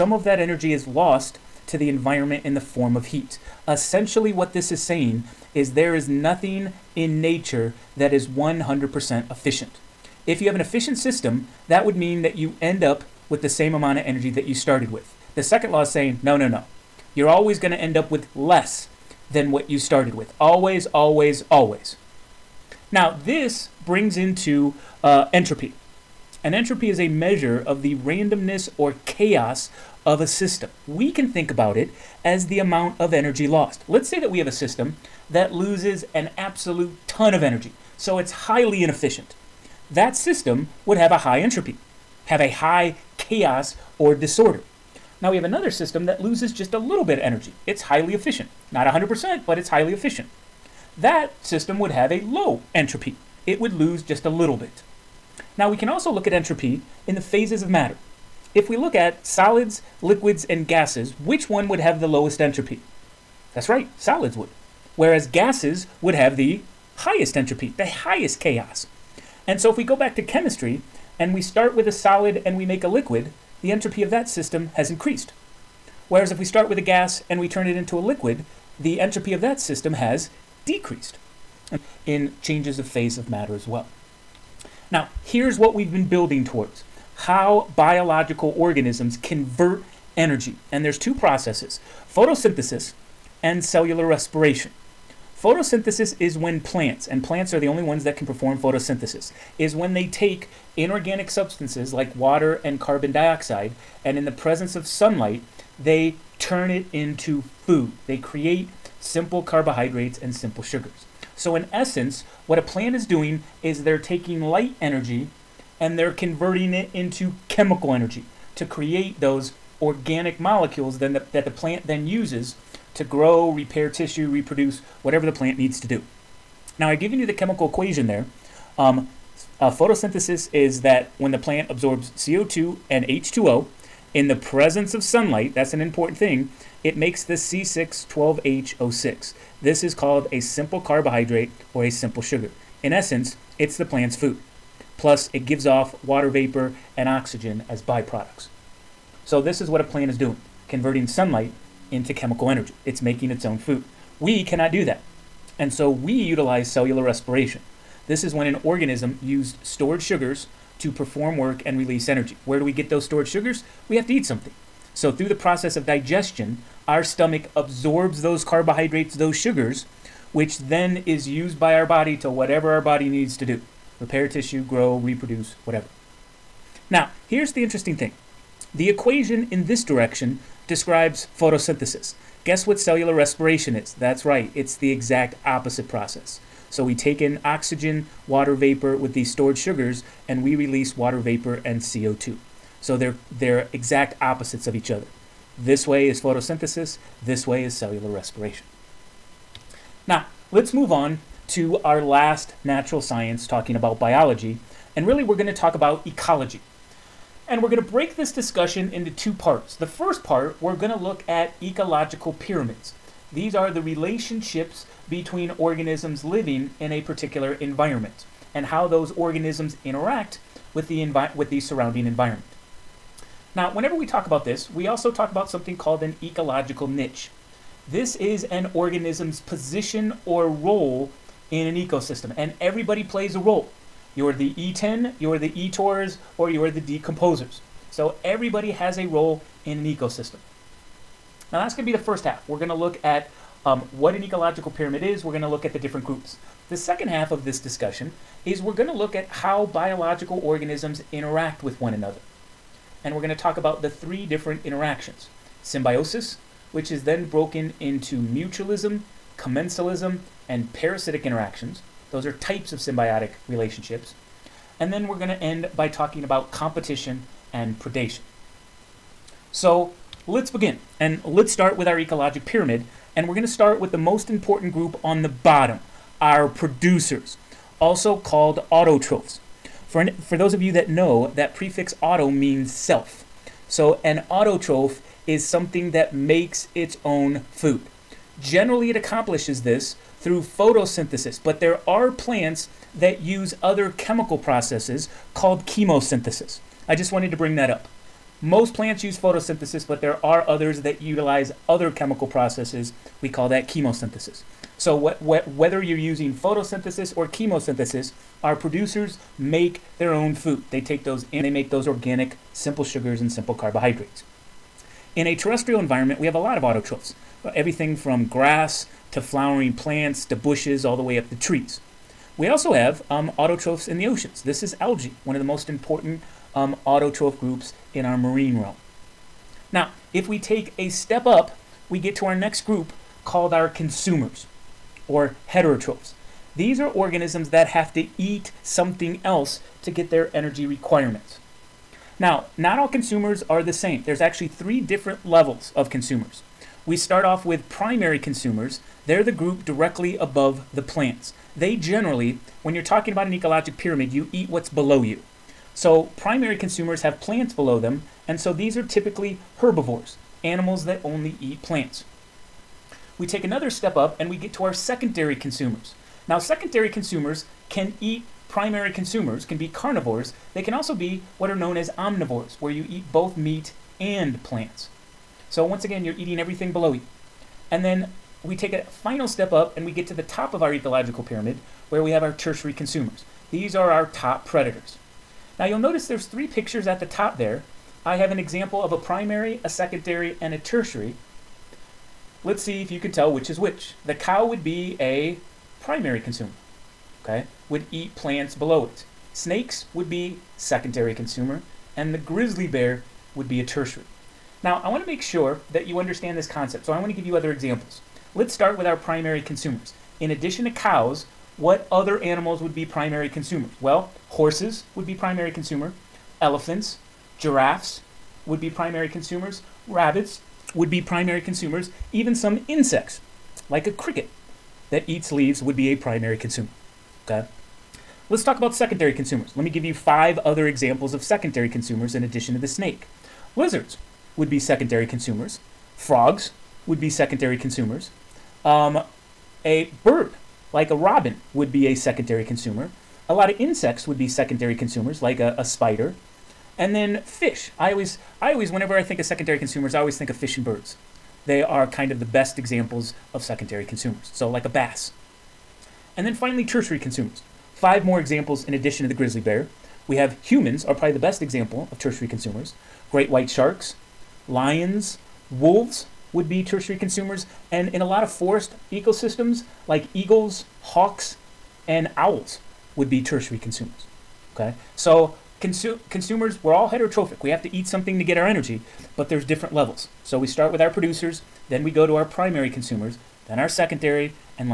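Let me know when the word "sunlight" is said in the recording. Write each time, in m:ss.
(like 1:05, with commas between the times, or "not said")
1:44, 2:15, 2:31.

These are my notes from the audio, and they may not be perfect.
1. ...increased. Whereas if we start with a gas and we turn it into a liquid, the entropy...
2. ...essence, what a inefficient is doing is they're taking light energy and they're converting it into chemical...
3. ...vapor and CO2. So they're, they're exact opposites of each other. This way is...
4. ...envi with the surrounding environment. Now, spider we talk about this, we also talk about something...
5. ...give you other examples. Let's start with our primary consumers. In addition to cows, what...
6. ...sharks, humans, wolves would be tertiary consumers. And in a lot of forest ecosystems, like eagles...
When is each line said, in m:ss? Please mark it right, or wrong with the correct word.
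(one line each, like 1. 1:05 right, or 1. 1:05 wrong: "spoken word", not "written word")
1. 1:14 right
2. 1:51 wrong: "plant", not "inefficient"
3. 3:11 right
4. 3:41 wrong: "whenever", not "spider"
5. 6:47 right
6. 7:43 wrong: "lions", not "humans".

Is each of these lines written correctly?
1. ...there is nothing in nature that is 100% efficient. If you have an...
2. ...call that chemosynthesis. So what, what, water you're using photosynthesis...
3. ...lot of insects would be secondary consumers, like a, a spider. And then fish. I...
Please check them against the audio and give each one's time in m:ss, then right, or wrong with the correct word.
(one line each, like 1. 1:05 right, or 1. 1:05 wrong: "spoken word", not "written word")
1. 0:05 right
2. 5:03 wrong: "whether", not "water"
3. 7:23 right.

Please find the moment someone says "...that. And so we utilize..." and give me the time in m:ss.
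2:34.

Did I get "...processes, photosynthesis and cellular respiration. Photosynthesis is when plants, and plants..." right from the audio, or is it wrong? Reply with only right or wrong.
right.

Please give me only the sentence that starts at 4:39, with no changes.
For, an, for those of you that know, that prefix auto means self.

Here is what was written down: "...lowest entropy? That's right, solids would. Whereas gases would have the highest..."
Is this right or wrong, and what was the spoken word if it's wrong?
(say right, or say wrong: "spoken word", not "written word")
right.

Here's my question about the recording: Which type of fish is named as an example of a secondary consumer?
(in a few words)
Bass.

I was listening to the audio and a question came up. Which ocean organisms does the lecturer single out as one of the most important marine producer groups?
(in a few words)
Algae.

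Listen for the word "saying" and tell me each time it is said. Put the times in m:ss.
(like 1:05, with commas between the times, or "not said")
0:04, 0:15.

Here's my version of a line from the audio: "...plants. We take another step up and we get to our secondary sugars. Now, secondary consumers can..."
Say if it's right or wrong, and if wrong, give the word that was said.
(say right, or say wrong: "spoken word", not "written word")
wrong: "consumers", not "sugars".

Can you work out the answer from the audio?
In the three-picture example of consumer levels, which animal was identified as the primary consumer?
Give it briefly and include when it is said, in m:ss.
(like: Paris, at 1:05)
The cow, at 6:34.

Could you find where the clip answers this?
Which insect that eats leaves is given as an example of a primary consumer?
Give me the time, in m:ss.
7:03.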